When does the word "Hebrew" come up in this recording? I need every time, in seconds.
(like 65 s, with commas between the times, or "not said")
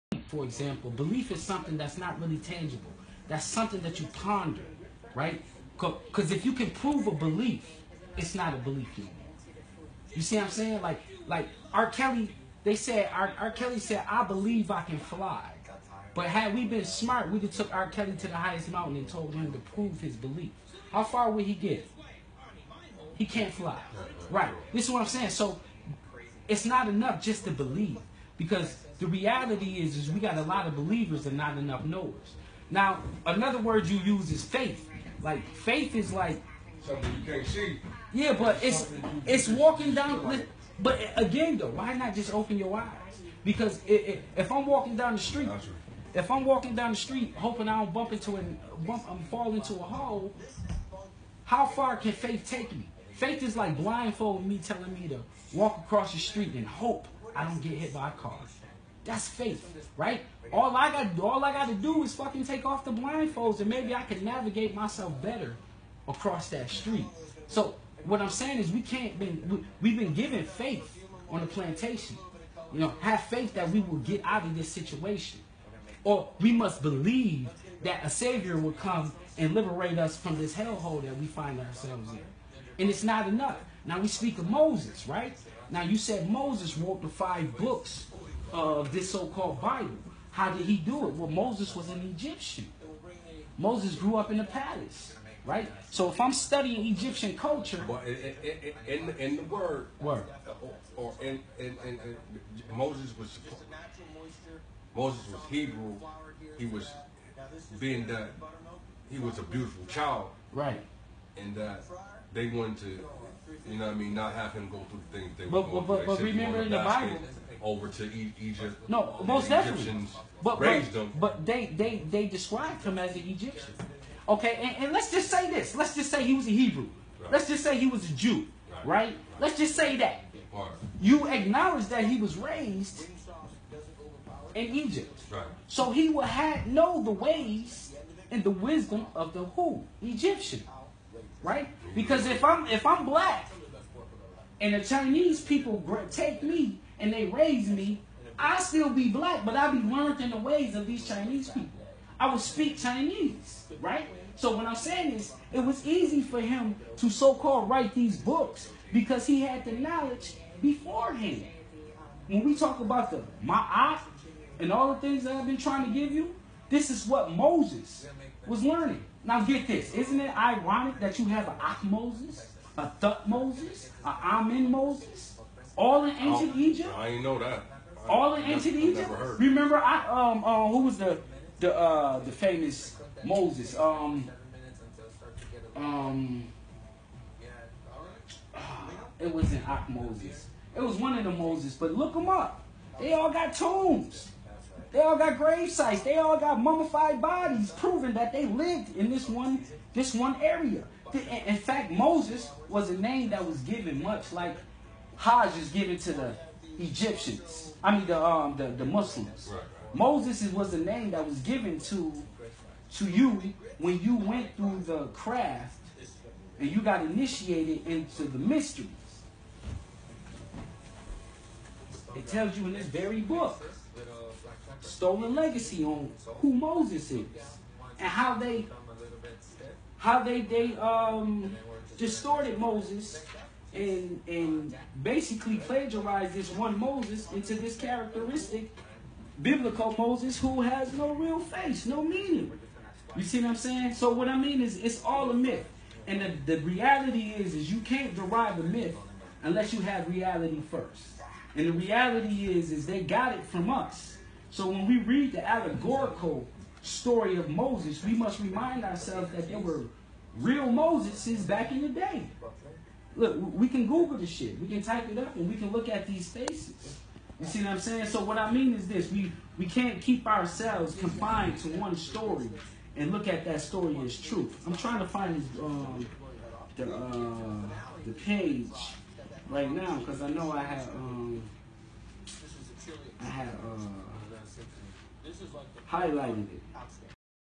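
105 s, 126 s.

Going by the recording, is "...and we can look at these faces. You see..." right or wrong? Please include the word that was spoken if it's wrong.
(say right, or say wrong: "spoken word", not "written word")
right.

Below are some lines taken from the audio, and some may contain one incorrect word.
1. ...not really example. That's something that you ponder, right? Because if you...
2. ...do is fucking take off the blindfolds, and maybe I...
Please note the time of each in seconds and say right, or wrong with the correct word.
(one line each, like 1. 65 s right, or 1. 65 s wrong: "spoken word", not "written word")
1. 1 s wrong: "tangible", not "example"
2. 61 s right.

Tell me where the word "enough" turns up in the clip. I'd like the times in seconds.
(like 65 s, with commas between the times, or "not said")
26 s, 31 s, 83 s.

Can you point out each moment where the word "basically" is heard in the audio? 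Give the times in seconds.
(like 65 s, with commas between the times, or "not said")
235 s.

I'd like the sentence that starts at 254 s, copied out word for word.
So when we read the allegorical story of Moses, we must remind ourselves that there were real Moseses back in the day.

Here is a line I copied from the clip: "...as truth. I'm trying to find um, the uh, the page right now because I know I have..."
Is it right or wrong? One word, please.
right.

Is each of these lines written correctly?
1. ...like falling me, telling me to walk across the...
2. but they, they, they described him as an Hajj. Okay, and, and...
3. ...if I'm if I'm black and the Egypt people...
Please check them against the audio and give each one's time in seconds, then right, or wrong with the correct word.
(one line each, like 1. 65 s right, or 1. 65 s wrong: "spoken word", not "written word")
1. 53 s wrong: "blindfolding", not "falling"
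2. 121 s wrong: "Egyptian", not "Hajj"
3. 142 s wrong: "Chinese", not "Egypt".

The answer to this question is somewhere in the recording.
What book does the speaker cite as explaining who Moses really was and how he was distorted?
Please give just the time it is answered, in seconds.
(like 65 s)
224 s.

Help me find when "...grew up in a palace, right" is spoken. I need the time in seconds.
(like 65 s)
93 s.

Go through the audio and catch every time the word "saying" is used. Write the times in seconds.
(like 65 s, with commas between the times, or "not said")
10 s, 25 s, 68 s, 154 s, 243 s, 267 s.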